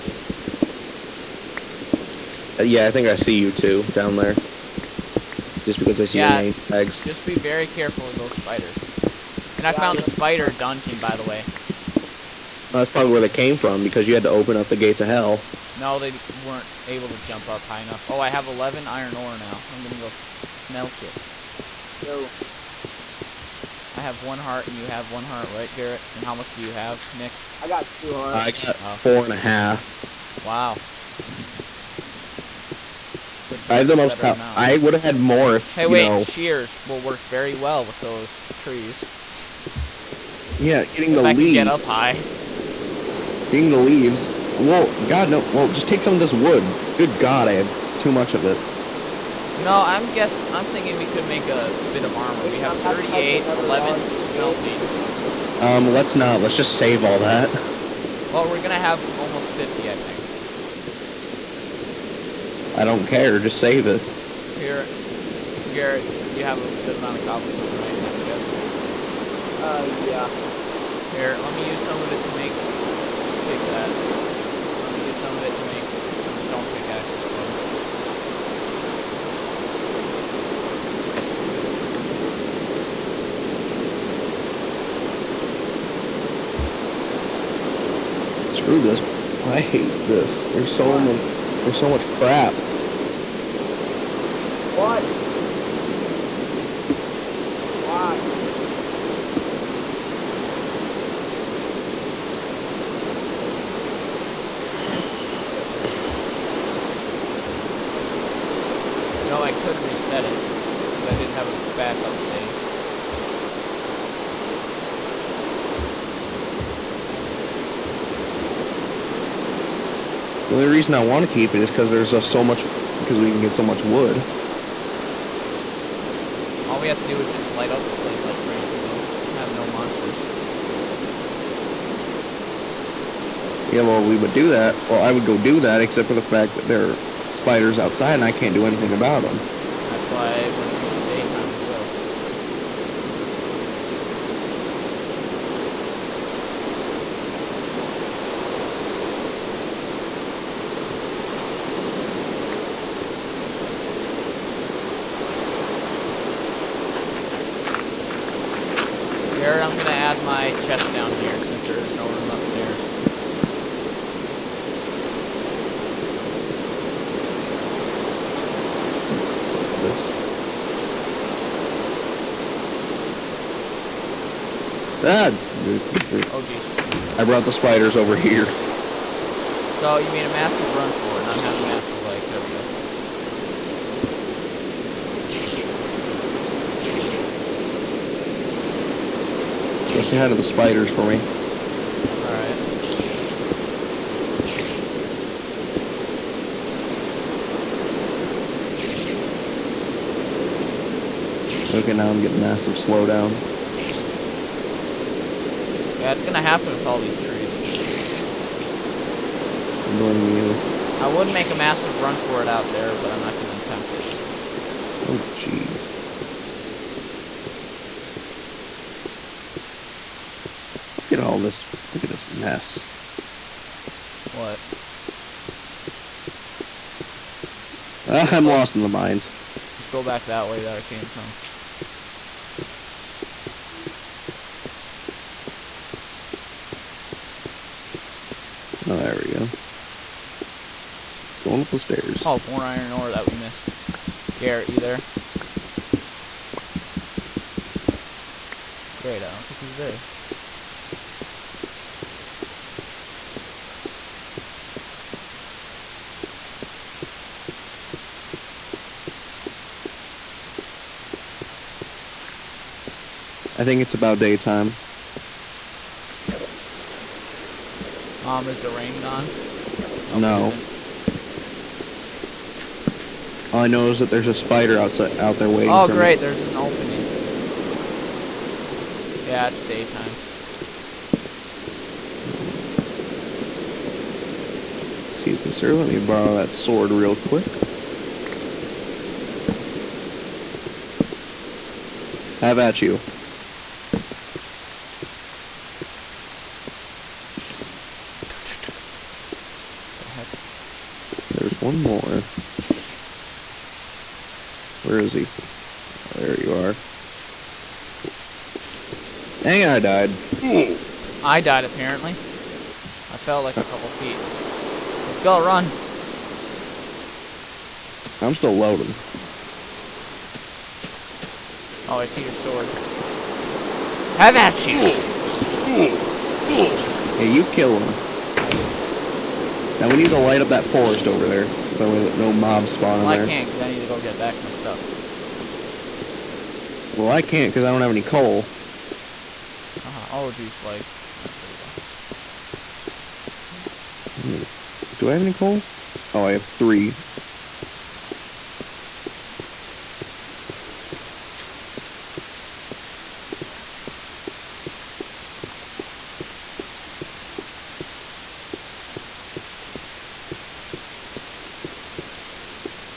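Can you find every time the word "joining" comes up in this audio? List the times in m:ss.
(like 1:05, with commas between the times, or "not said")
not said.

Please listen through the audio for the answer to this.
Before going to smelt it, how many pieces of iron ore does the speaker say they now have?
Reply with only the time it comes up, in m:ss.
0:18.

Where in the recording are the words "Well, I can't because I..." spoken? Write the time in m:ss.
5:36.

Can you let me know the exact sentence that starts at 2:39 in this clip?
Jared, I'm going to add my chest down here since there is no room upstairs.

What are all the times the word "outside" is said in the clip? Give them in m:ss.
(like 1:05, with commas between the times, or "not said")
2:17, 4:34.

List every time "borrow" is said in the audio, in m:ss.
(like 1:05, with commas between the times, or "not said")
4:45.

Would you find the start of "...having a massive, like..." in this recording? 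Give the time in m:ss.
3:01.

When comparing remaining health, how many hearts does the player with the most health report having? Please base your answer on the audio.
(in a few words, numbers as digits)
4.5.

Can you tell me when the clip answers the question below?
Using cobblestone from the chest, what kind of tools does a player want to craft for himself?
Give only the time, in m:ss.
1:16.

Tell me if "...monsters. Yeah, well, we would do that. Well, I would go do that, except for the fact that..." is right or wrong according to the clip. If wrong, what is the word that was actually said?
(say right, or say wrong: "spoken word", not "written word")
right.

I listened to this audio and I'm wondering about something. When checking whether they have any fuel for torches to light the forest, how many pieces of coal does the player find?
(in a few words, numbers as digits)
3.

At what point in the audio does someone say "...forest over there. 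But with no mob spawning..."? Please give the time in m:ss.
5:30.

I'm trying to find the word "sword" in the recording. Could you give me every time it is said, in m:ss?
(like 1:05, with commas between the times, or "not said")
4:46, 5:22.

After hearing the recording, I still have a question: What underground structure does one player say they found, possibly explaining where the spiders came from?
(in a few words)
spider dungeon.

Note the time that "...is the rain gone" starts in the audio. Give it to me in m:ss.
4:28.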